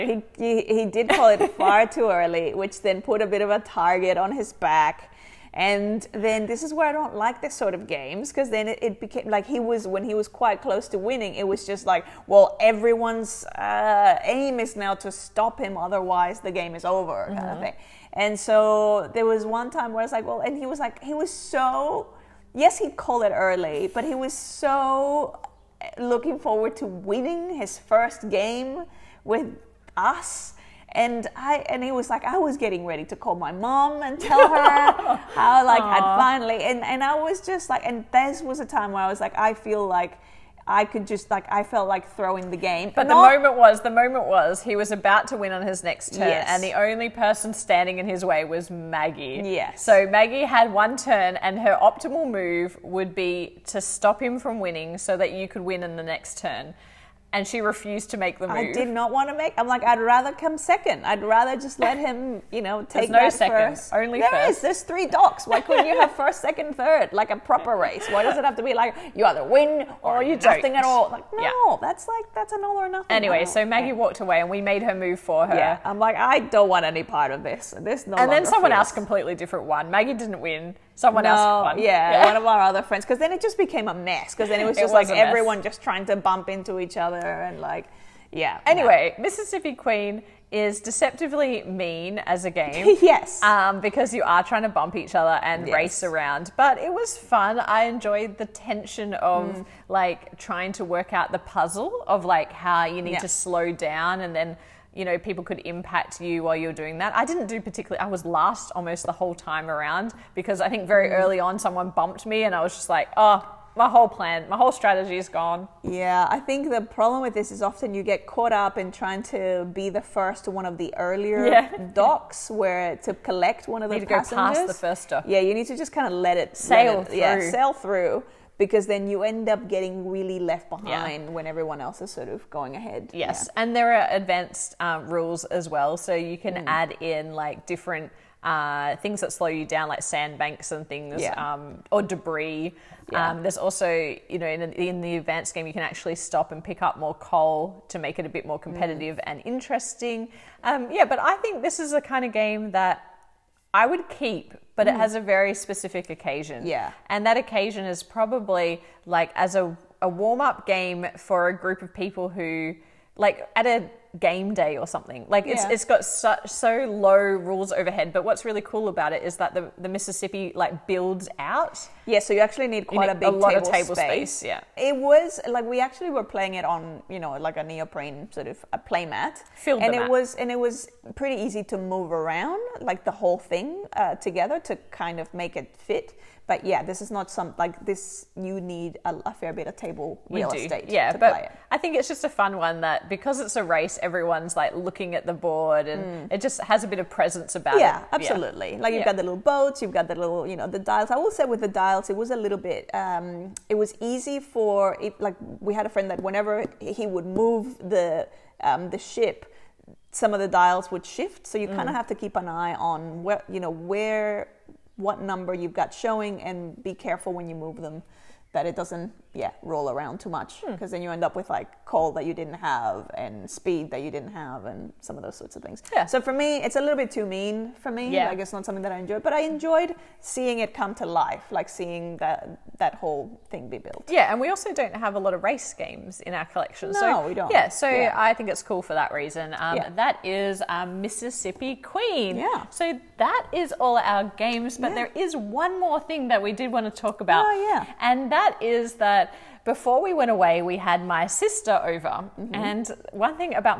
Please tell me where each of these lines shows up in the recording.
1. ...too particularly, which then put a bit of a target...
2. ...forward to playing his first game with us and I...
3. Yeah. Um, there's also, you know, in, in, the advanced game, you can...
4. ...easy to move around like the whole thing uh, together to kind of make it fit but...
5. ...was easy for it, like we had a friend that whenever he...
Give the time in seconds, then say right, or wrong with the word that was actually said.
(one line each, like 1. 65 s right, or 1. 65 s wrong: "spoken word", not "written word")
1. 1 s wrong: "early", not "particularly"
2. 26 s wrong: "winning", not "playing"
3. 143 s right
4. 181 s right
5. 203 s right.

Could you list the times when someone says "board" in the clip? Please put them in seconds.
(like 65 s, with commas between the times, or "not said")
195 s.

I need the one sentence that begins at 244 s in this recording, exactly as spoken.
there is one more thing that we did want to talk about.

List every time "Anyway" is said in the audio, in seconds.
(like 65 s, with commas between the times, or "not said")
73 s, 88 s.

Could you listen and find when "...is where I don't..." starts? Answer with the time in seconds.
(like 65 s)
6 s.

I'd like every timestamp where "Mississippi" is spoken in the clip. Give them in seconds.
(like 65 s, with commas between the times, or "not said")
89 s, 169 s, 240 s.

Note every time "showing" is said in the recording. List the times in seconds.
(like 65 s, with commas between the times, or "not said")
215 s.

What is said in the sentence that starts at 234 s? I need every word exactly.
Yeah, and we also don't have a lot of race games in our collection.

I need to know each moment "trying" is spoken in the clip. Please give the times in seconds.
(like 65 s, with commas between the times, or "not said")
85 s, 94 s, 100 s, 118 s.